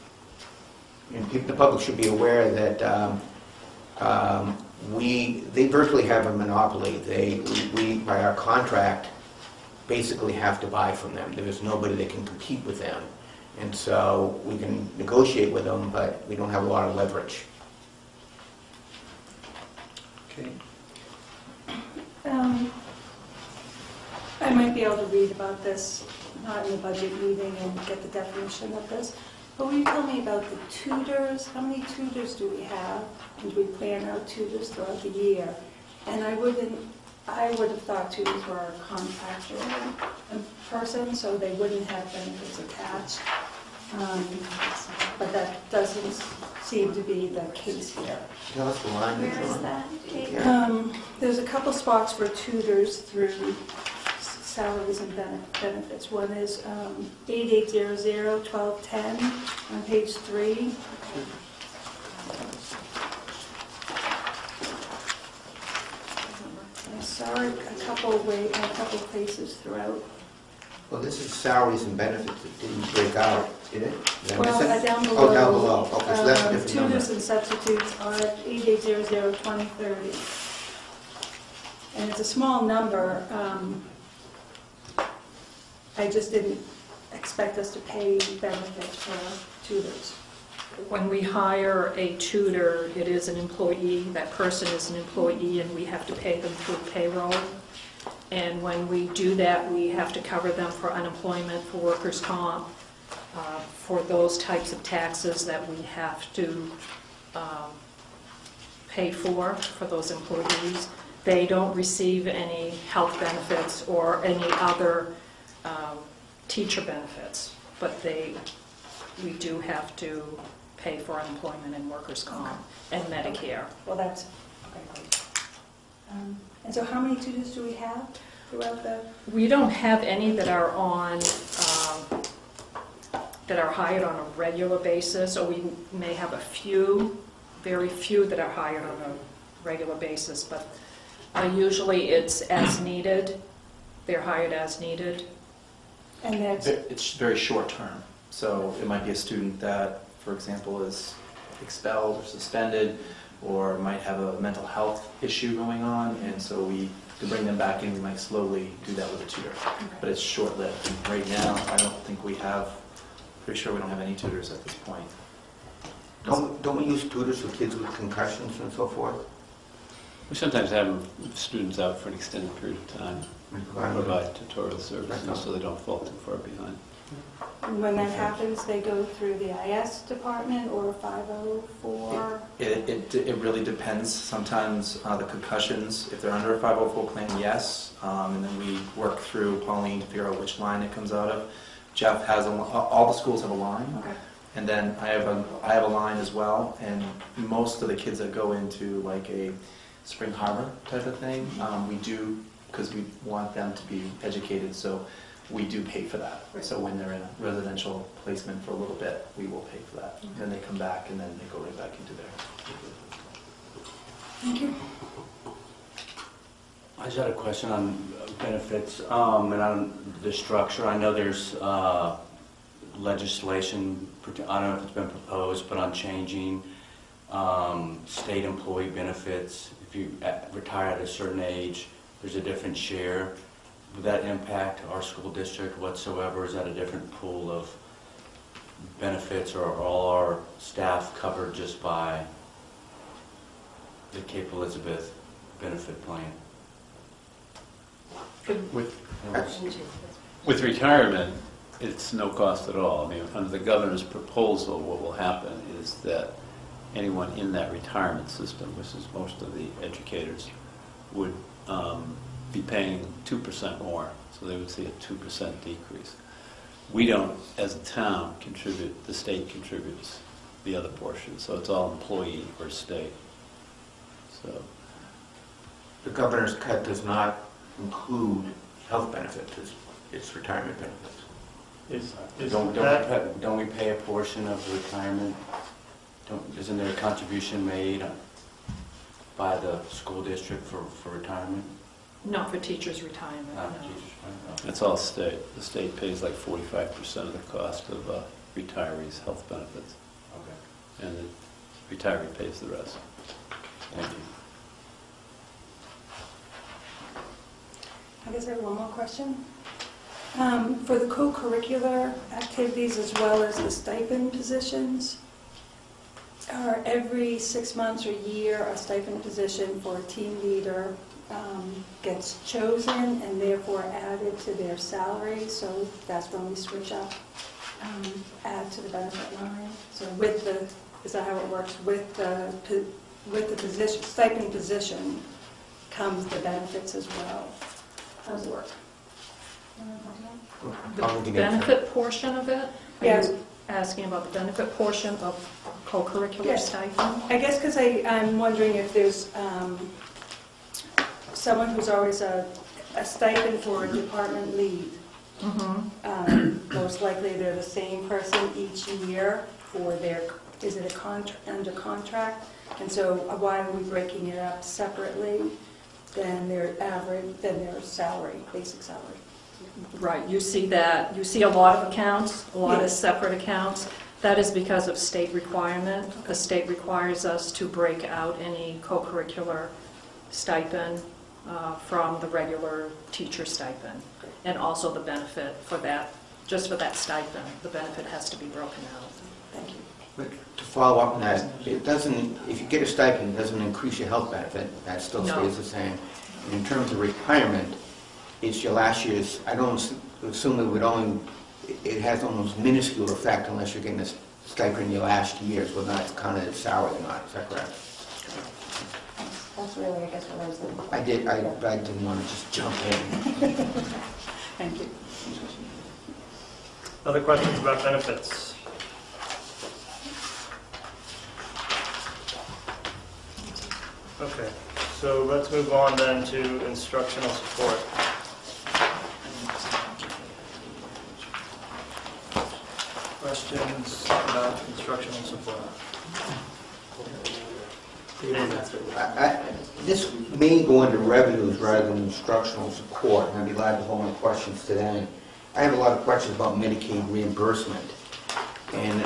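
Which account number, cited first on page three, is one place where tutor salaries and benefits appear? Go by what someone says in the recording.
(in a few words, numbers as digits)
8800-1210.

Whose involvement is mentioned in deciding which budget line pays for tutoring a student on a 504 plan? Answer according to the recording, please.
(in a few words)
Pauline.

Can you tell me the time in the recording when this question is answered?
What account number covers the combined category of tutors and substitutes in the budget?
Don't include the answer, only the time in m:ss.
1:19.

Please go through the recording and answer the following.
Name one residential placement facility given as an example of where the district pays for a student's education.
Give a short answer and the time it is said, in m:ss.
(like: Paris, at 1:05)
Spring Harbor, at 3:20.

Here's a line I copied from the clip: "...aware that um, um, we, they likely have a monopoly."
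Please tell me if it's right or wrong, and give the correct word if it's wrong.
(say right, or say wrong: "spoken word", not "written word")
wrong: "virtually", not "likely".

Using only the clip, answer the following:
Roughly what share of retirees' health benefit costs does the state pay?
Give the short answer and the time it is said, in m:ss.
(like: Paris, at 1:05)
45%, at 4:56.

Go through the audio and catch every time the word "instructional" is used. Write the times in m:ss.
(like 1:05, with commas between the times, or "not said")
7:06, 7:14, 7:22.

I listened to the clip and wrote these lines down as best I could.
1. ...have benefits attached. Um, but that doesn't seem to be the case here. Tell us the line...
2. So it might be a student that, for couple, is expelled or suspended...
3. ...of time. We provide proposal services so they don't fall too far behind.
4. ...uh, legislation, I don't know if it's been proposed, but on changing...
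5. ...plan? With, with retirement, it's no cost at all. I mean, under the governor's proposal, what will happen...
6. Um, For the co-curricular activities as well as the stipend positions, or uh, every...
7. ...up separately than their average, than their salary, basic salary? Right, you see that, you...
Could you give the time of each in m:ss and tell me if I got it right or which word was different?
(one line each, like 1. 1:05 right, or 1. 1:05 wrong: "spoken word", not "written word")
1. 0:41 right
2. 2:28 wrong: "example", not "couple"
3. 2:52 wrong: "tutorial", not "proposal"
4. 3:41 right
5. 4:06 right
6. 5:10 right
7. 6:04 right.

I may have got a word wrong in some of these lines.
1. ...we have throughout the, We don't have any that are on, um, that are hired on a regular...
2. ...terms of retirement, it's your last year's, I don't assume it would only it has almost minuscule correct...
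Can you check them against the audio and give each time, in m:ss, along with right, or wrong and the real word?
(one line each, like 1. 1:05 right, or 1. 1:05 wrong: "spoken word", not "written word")
1. 2:07 right
2. 6:36 wrong: "effect", not "correct".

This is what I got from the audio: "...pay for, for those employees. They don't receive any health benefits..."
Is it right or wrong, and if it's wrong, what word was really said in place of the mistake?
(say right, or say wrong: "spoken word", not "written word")
right.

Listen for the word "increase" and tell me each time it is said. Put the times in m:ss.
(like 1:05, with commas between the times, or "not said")
6:33.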